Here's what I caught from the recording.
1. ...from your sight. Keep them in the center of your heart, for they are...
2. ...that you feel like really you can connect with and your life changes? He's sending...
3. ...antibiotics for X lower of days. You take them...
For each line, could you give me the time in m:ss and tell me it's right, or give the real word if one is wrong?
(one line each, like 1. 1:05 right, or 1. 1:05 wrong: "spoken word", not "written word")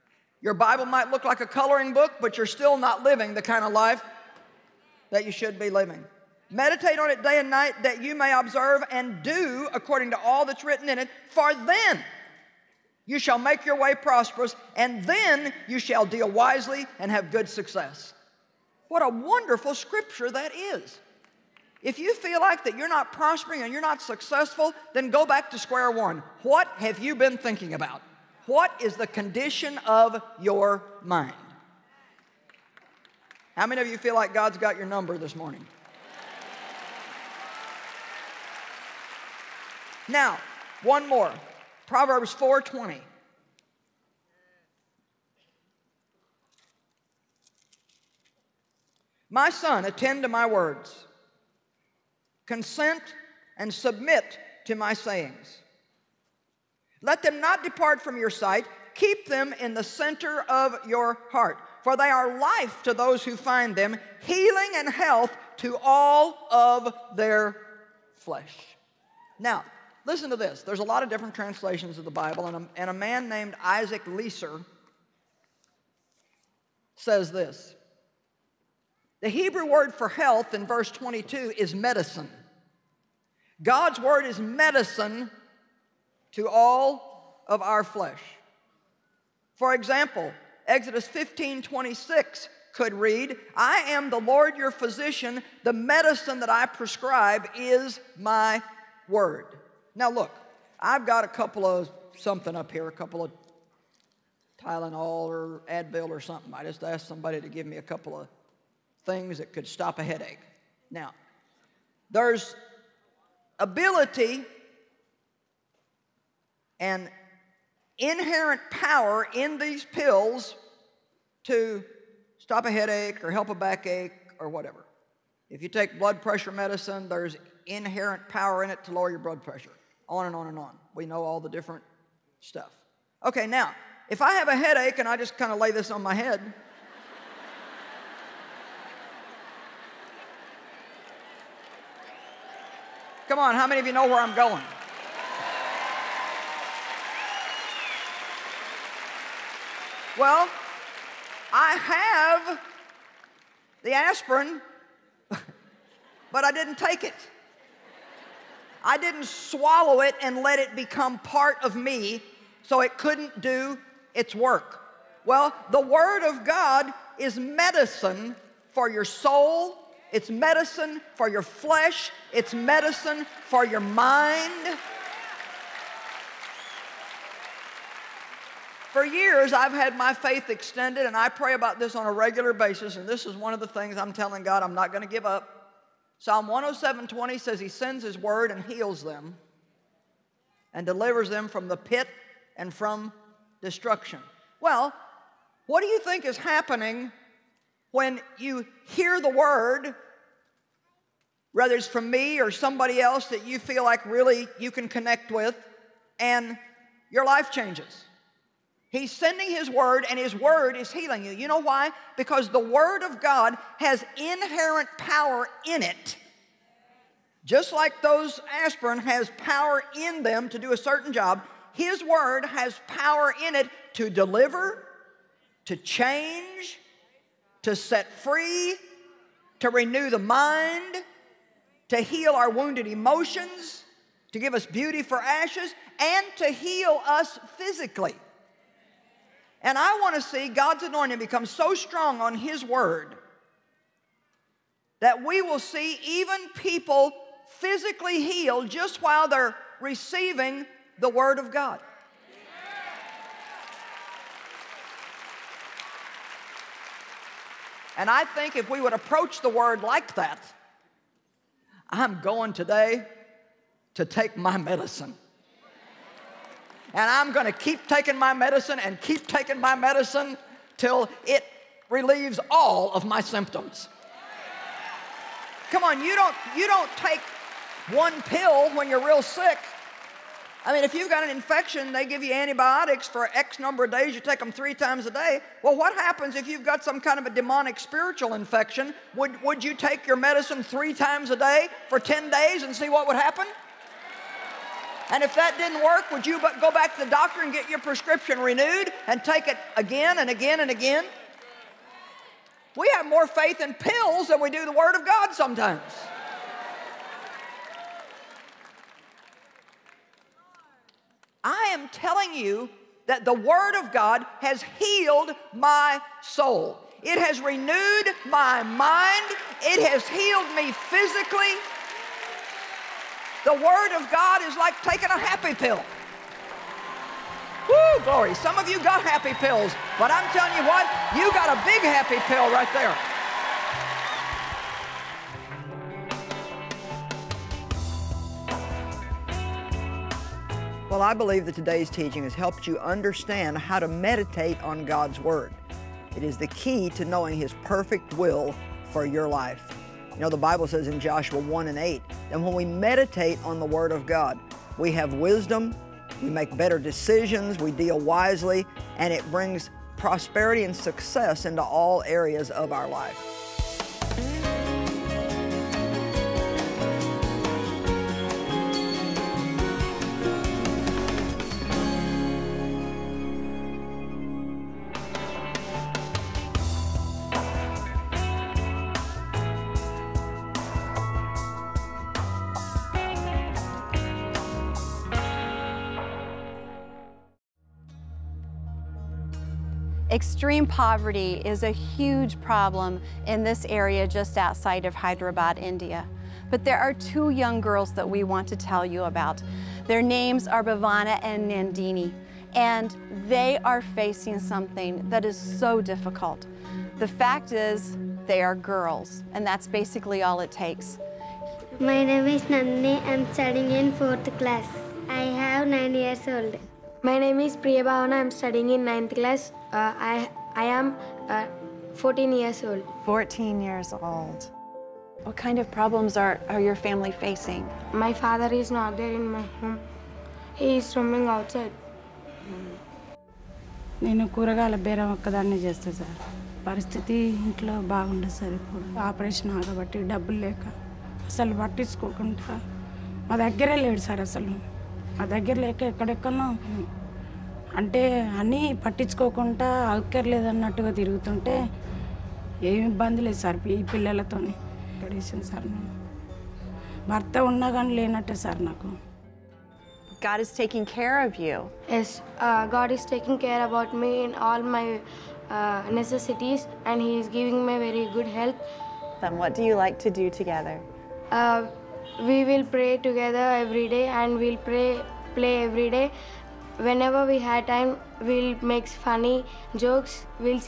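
1. 0:58 right
2. 3:23 right
3. 4:42 wrong: "number", not "lower".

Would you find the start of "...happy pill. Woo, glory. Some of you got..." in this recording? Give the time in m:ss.
5:25.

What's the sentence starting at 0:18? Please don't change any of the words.
What a wonderful scripture that is.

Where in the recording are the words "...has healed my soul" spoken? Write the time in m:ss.
5:14.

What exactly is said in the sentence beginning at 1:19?
The Hebrew word for health in verse 22 is medicine.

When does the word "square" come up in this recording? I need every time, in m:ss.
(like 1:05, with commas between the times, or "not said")
0:25.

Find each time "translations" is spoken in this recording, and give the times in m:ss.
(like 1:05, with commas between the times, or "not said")
1:11.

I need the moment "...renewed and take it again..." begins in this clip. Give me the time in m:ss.
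4:58.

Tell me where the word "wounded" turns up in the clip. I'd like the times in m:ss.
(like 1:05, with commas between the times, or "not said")
3:52.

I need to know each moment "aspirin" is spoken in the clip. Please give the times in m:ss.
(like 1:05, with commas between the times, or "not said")
2:33, 3:38.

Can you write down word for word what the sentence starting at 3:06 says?
Psalm 107:20 says he sends his word and heals them and delivers them from the pit and from destruction.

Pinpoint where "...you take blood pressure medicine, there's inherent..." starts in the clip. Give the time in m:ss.
2:05.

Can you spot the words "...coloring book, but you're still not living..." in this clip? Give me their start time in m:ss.
0:01.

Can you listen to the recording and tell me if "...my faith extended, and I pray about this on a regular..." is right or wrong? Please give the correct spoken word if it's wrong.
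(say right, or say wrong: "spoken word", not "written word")
right.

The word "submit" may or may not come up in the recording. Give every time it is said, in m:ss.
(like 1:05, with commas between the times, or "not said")
0:53.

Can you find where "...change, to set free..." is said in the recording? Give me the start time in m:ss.
3:45.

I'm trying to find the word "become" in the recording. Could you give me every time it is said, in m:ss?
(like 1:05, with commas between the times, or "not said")
2:40, 4:01.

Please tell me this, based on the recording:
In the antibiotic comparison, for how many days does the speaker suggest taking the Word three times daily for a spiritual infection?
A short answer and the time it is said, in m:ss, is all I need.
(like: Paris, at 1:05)
10 days, at 4:51.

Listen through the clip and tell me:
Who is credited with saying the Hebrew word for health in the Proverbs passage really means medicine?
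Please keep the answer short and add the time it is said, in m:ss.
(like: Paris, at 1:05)
Isaac Leeser, at 1:13.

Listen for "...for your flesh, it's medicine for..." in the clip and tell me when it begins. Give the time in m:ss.
2:51.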